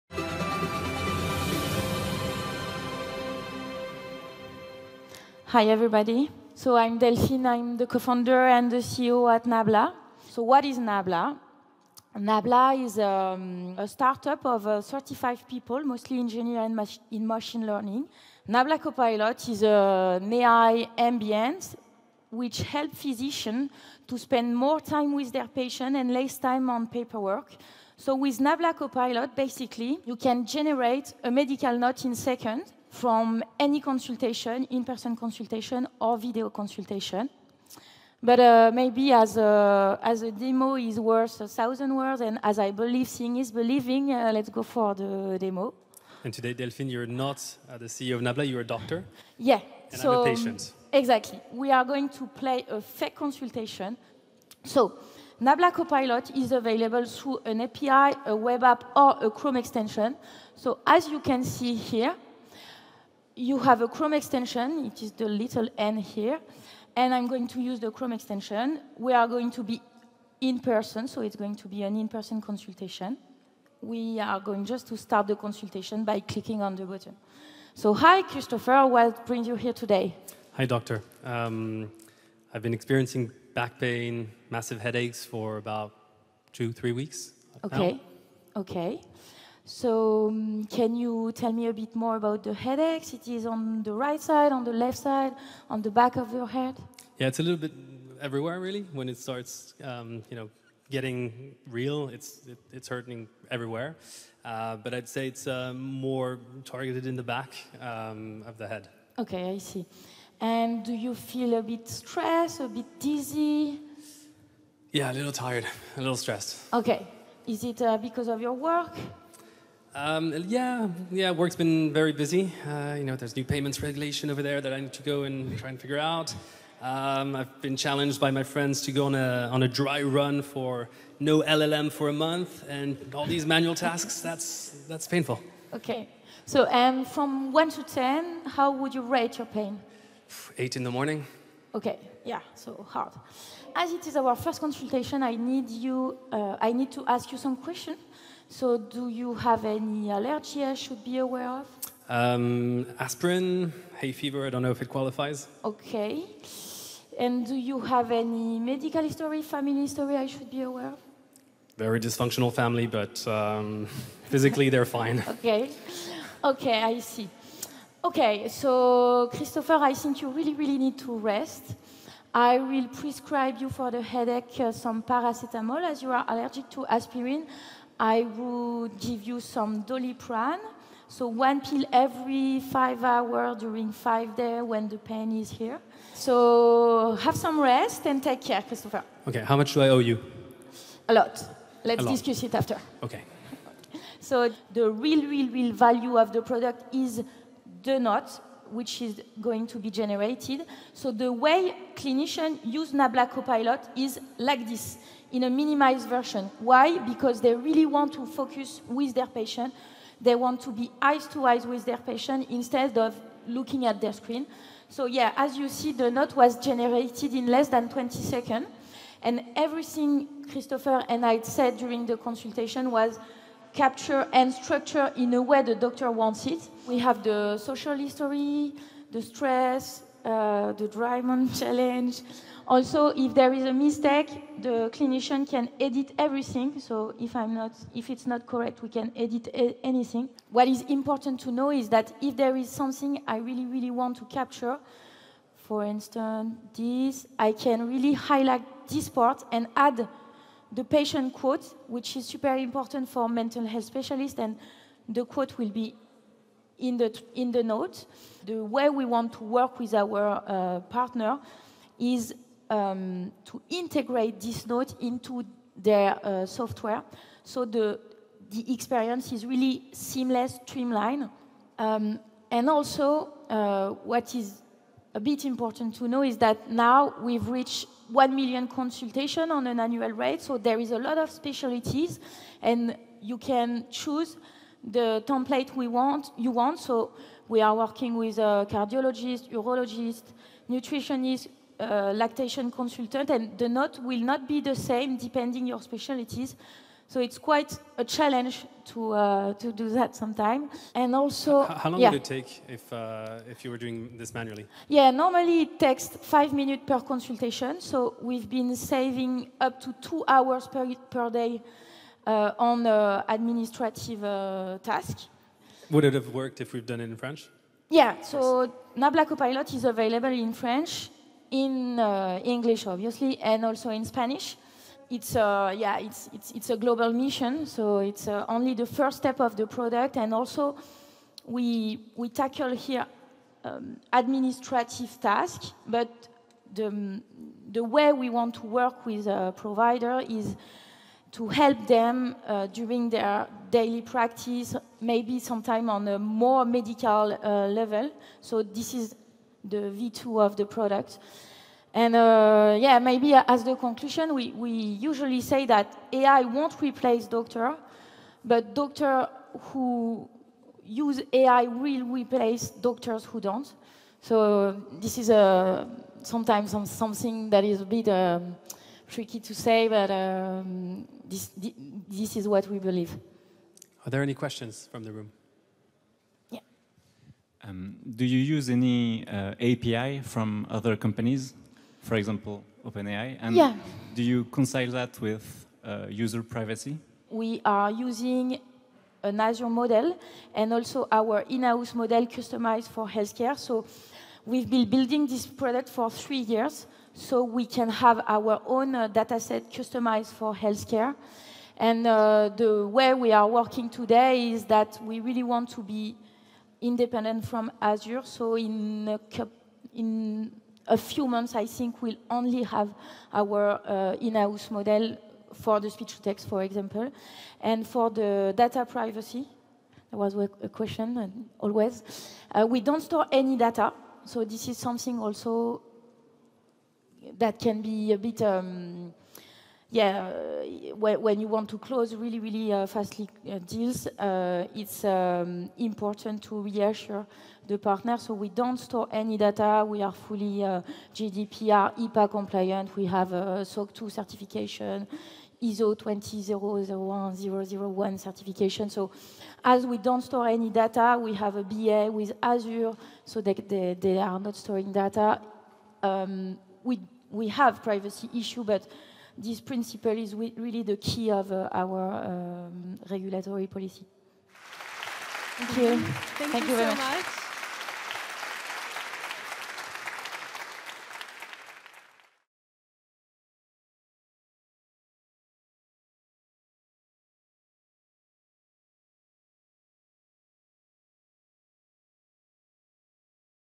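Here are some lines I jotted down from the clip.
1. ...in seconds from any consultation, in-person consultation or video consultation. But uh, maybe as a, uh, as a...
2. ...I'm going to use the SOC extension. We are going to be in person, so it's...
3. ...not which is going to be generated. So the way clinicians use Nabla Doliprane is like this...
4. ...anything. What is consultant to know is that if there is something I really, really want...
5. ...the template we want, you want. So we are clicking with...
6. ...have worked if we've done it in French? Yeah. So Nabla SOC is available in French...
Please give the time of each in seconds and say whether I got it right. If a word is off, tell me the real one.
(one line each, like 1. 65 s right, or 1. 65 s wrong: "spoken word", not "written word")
1. 32 s right
2. 67 s wrong: "Chrome", not "SOC"
3. 197 s wrong: "Copilot", not "Doliprane"
4. 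239 s wrong: "important", not "consultant"
5. 284 s wrong: "working", not "clicking"
6. 316 s wrong: "Copilot", not "SOC".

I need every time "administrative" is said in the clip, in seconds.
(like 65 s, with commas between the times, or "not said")
313 s, 334 s.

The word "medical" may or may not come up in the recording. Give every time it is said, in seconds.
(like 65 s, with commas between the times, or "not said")
31 s, 158 s, 346 s.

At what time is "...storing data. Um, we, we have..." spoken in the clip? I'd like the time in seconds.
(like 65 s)
454 s.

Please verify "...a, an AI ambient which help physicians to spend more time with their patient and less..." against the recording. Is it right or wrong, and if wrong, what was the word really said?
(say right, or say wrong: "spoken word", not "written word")
right.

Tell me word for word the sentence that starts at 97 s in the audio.
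Yeah, it's a little bit everywhere really.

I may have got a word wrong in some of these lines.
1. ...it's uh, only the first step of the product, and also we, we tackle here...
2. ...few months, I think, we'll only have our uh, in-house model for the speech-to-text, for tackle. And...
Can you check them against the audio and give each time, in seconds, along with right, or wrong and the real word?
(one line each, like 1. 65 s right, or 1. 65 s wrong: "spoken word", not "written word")
1. 327 s right
2. 410 s wrong: "example", not "tackle".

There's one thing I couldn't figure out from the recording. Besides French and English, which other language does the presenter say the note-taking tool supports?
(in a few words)
Spanish.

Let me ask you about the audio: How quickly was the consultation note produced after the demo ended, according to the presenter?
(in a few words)
less than 20 seconds.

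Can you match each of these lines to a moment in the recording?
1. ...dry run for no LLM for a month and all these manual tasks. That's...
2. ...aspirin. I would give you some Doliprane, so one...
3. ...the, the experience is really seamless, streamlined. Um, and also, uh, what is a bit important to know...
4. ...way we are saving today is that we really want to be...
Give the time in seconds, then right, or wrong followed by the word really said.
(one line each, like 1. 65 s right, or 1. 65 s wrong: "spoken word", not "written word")
1. 129 s right
2. 176 s right
3. 267 s right
4. 402 s wrong: "working", not "saving".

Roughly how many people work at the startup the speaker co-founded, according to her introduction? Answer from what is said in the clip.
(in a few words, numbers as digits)
35.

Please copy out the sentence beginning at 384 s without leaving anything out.
do you reconcile that with uh, user privacy?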